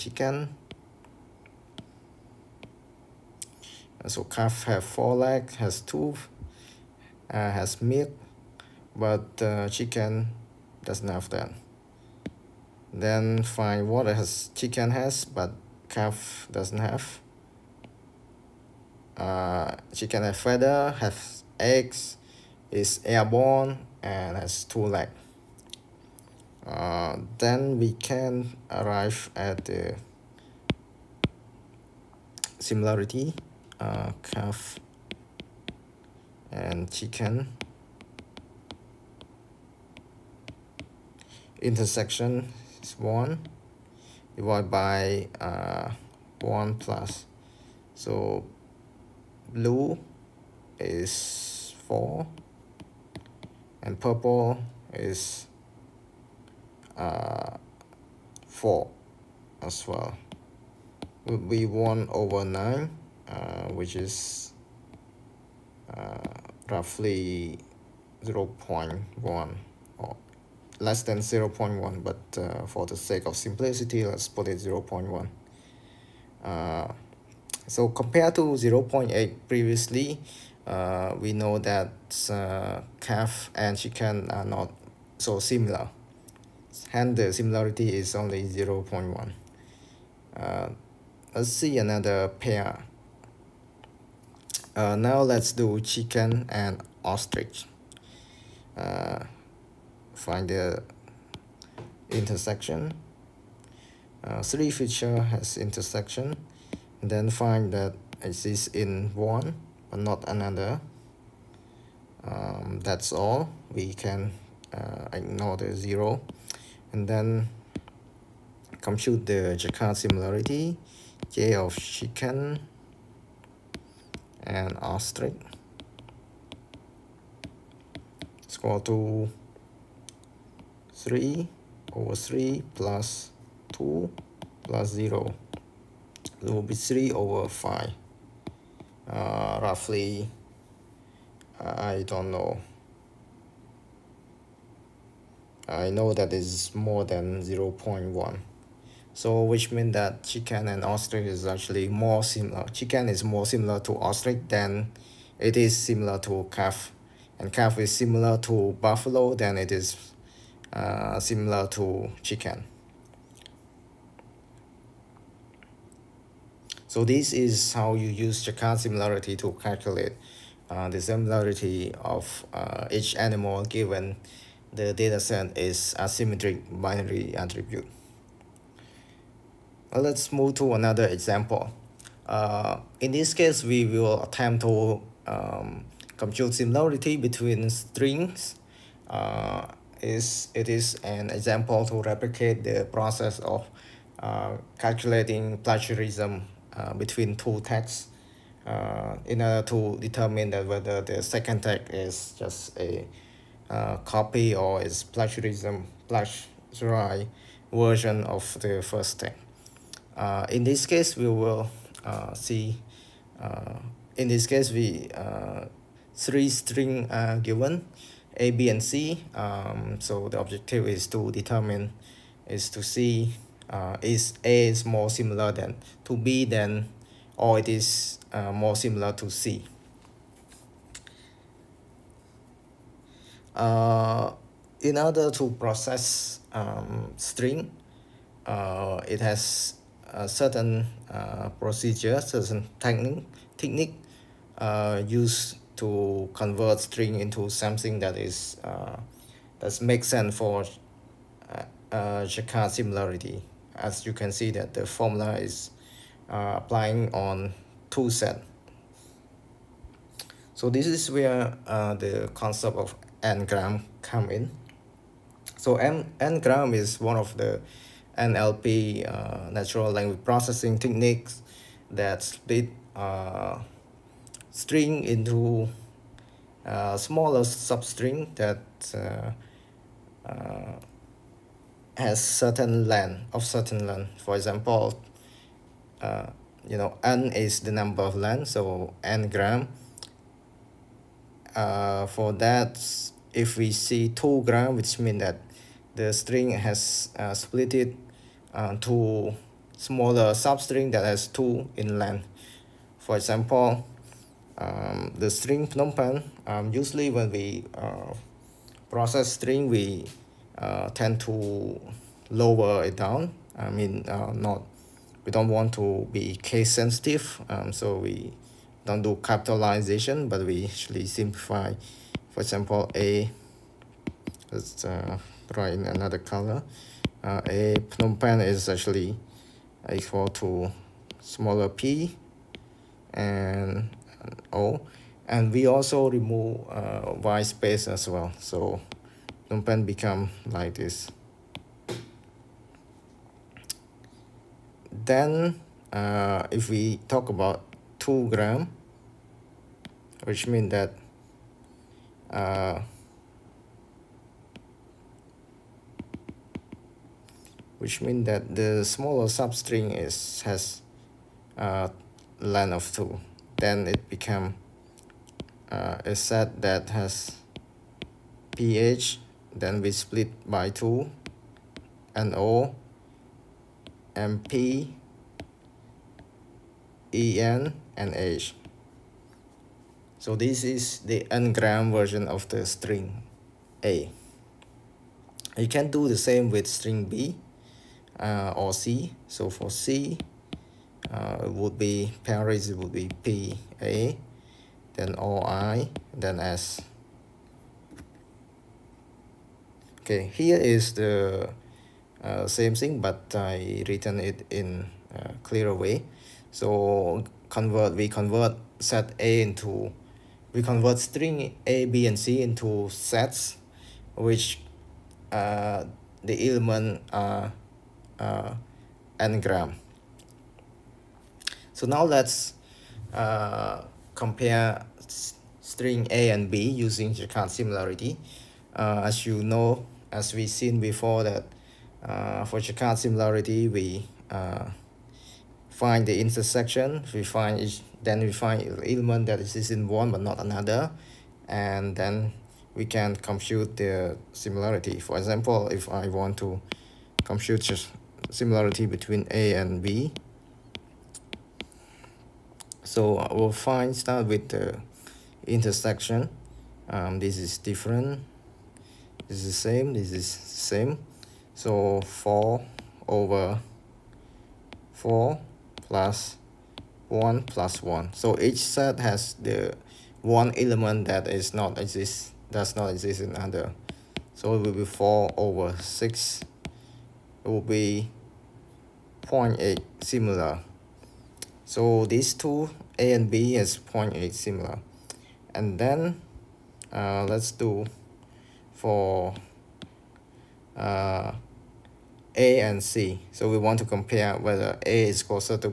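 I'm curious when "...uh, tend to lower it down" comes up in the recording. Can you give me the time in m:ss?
5:10.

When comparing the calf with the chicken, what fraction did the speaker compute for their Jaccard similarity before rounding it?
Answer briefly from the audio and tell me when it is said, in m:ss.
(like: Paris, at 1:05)
1/9, at 1:01.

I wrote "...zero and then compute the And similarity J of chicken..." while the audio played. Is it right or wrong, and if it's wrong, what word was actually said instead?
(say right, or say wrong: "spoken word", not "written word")
wrong: "Jaccard", not "And".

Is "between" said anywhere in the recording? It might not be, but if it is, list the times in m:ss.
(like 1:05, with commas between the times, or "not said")
3:07, 3:16, 7:28.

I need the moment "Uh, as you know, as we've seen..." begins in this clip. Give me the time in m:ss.
7:08.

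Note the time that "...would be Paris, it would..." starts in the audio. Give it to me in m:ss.
6:31.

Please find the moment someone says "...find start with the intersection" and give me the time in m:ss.
7:33.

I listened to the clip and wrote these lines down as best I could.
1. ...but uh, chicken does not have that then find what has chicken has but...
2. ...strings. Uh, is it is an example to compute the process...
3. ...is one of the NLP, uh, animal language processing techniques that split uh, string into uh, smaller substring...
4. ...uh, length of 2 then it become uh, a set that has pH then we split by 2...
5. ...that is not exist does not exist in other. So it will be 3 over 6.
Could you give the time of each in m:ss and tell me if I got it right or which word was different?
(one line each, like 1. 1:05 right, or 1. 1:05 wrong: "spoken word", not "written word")
1. 0:08 right
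2. 3:07 wrong: "replicate", not "compute"
3. 4:26 wrong: "natural", not "animal"
4. 6:01 right
5. 7:51 wrong: "4", not "3".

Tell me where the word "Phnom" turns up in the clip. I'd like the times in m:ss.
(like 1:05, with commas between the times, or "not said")
5:05, 5:27, 5:39.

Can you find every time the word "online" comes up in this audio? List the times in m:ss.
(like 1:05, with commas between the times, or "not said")
not said.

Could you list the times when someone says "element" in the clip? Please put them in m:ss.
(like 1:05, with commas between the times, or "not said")
6:56, 7:18, 7:50.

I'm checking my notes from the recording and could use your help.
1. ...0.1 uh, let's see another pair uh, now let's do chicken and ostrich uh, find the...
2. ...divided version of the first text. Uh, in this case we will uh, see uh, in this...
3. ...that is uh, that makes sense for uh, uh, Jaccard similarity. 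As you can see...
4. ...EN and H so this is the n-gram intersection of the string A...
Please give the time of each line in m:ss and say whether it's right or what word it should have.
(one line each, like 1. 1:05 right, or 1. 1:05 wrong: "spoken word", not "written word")
1. 1:28 right
2. 3:26 wrong: "plagiarized", not "divided"
3. 4:07 right
4. 6:17 wrong: "version", not "intersection".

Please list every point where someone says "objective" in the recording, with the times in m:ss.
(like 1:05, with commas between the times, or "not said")
3:40.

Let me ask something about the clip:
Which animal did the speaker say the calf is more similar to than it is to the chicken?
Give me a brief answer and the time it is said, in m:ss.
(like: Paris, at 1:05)
Buffalo, at 2:38.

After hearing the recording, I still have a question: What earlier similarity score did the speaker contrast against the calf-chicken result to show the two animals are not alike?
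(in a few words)
0.8.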